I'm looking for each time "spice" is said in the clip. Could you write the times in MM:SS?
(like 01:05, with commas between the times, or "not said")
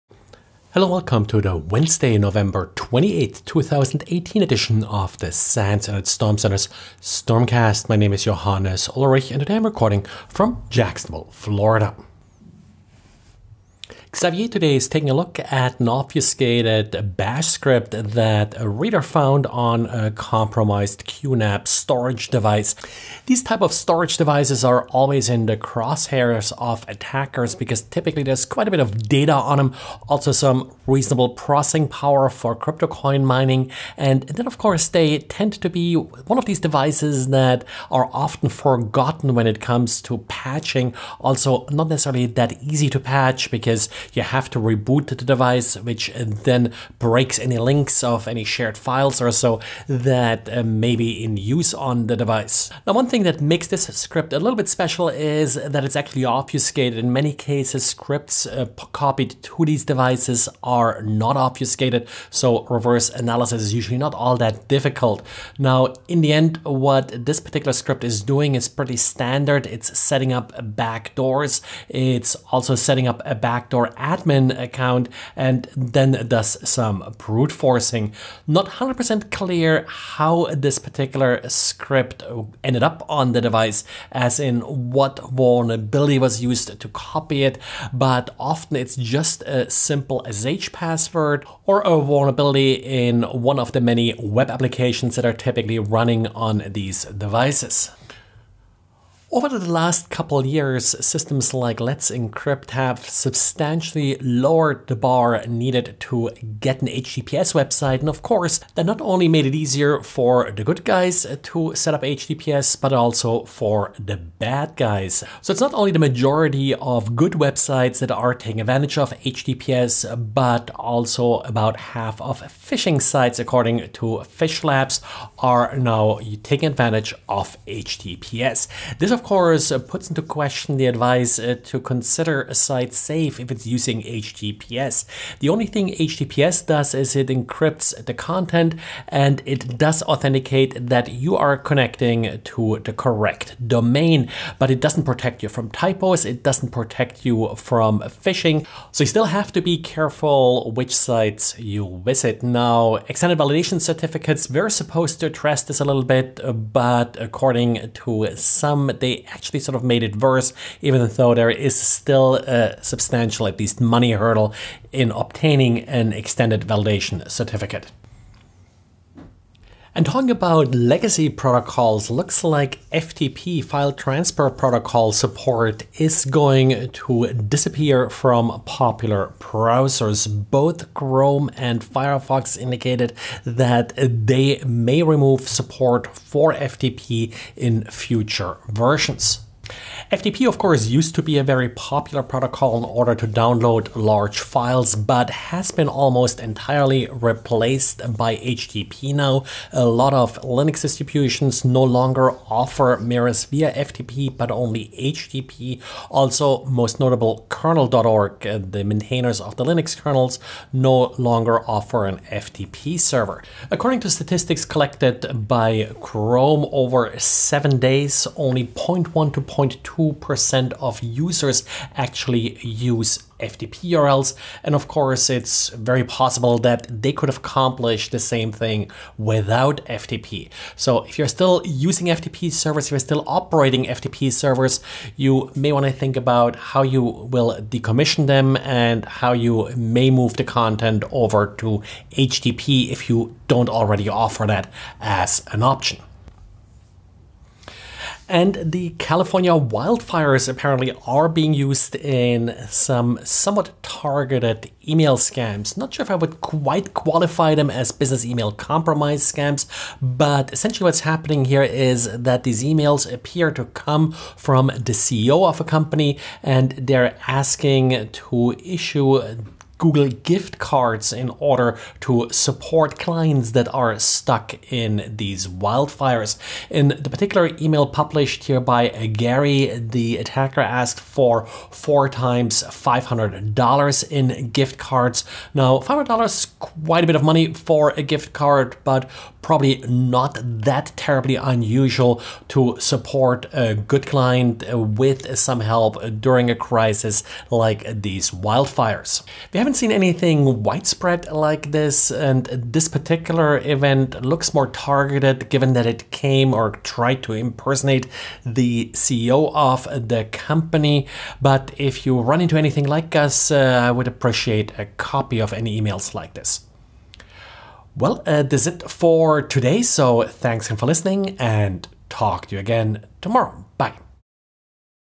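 not said.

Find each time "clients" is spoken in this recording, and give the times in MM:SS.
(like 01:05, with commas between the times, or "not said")
04:32, 04:54.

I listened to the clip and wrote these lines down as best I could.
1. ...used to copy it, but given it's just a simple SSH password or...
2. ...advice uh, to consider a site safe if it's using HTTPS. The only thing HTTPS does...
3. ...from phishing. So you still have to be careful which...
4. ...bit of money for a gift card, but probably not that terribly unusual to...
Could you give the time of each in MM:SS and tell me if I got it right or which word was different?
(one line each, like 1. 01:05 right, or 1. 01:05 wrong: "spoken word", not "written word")
1. 01:26 wrong: "often", not "given"
2. 02:10 right
3. 02:27 right
4. 04:47 right.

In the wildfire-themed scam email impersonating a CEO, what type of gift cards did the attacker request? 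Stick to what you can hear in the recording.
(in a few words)
Google gift cards.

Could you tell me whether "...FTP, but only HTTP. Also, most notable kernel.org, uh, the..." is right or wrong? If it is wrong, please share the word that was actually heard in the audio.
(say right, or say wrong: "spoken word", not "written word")
right.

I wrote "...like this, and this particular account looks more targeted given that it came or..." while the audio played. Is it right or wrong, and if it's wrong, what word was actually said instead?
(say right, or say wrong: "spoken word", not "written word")
wrong: "event", not "account".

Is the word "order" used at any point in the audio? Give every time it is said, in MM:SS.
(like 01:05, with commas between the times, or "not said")
03:12, 04:31.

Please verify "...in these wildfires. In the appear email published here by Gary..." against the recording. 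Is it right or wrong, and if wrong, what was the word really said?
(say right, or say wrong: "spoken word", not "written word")
wrong: "particular", not "appear".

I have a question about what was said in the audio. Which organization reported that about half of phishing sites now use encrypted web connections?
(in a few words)
PhishLabs.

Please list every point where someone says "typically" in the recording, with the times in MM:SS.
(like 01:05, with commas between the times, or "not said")
00:27, 01:35.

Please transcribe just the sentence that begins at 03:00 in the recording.
Both Chrome and Firefox indicated that they may remove support for FTP in future versions.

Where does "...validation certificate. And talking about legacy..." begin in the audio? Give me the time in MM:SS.
02:46.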